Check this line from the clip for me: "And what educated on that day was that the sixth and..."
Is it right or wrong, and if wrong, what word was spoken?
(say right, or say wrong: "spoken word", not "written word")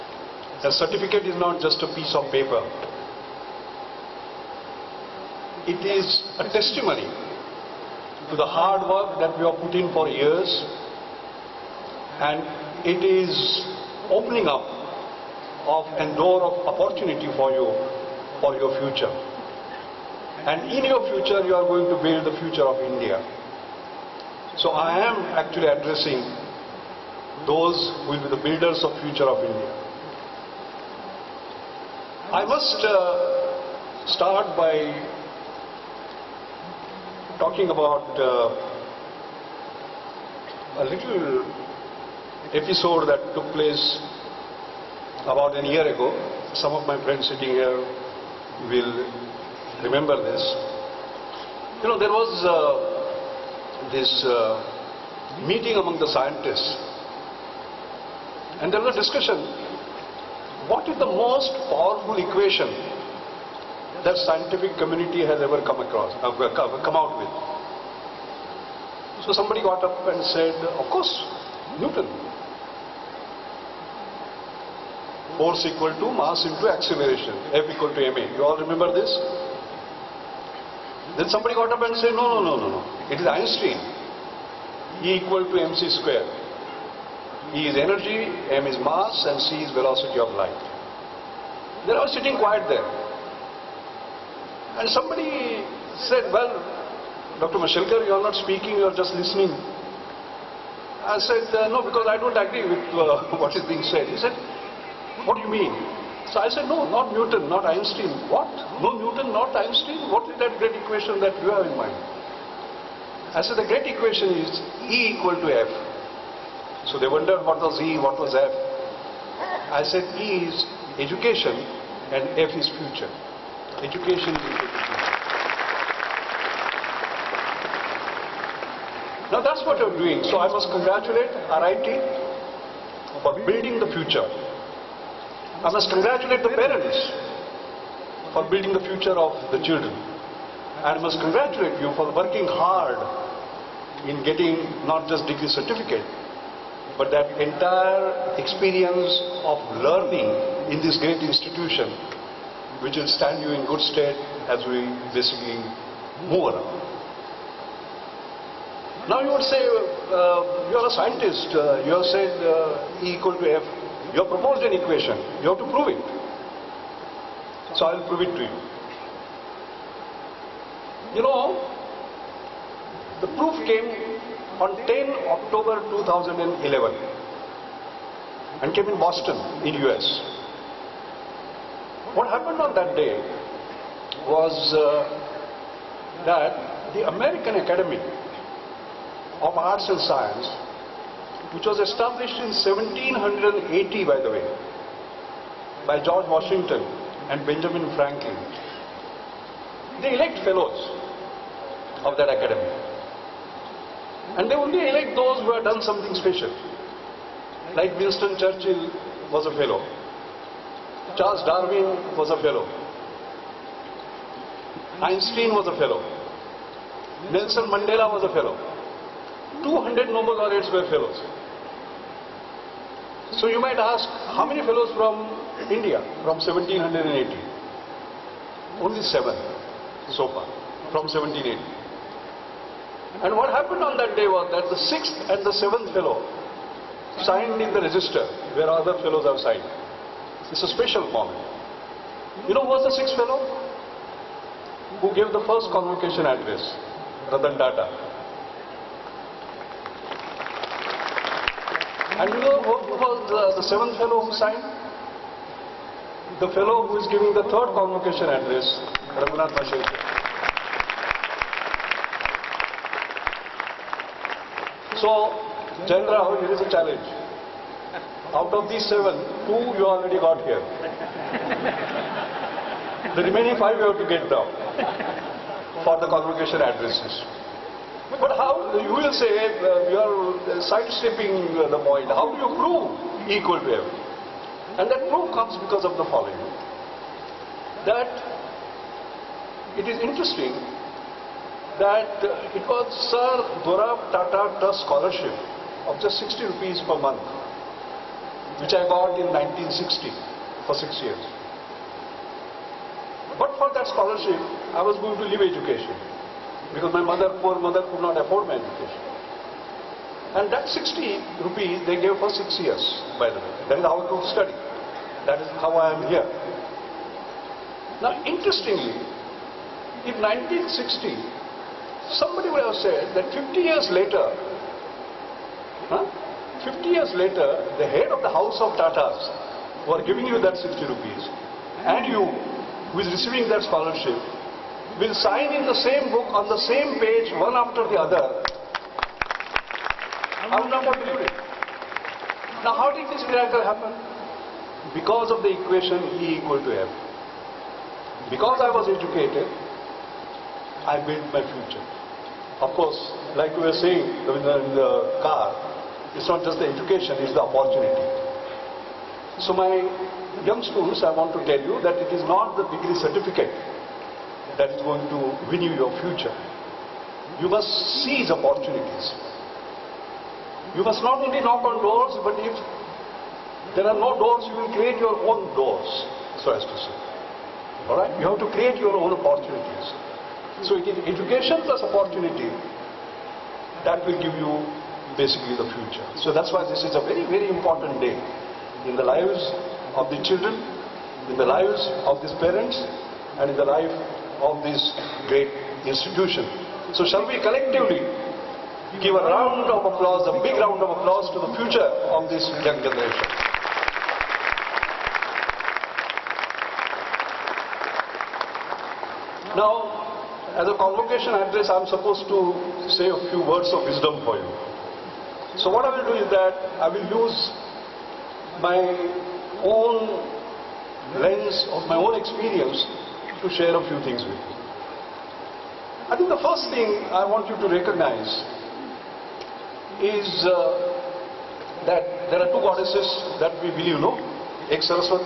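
wrong: "happened", not "educated".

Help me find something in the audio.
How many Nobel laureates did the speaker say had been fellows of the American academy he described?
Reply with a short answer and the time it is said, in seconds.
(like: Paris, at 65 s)
200, at 219 s.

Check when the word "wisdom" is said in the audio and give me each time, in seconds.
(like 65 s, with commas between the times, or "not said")
413 s.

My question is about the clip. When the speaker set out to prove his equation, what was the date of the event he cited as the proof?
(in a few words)
10 October 2011.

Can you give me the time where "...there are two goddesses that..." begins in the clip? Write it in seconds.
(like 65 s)
432 s.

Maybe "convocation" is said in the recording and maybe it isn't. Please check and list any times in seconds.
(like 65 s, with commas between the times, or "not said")
245 s, 257 s, 276 s, 410 s.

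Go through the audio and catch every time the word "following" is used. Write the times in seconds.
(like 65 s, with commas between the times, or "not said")
286 s.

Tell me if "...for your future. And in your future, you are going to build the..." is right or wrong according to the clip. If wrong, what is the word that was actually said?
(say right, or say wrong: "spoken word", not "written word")
right.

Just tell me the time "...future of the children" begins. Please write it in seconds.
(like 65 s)
138 s.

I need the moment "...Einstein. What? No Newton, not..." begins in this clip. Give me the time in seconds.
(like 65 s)
107 s.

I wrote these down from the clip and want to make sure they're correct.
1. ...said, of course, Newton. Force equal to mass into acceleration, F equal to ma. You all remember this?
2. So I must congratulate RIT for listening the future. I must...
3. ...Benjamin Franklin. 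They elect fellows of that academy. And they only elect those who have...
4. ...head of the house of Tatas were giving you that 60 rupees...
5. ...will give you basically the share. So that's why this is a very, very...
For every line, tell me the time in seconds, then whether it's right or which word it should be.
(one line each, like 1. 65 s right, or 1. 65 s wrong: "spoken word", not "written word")
1. 70 s right
2. 130 s wrong: "building", not "listening"
3. 197 s right
4. 327 s right
5. 384 s wrong: "future", not "share".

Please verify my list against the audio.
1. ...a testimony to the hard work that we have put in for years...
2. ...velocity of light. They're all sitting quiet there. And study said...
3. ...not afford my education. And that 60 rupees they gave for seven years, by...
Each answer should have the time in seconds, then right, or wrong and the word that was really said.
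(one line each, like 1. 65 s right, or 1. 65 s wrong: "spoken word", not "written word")
1. 6 s right
2. 89 s wrong: "somebody", not "study"
3. 308 s wrong: "six", not "seven".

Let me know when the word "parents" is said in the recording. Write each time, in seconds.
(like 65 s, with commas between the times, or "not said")
136 s, 392 s.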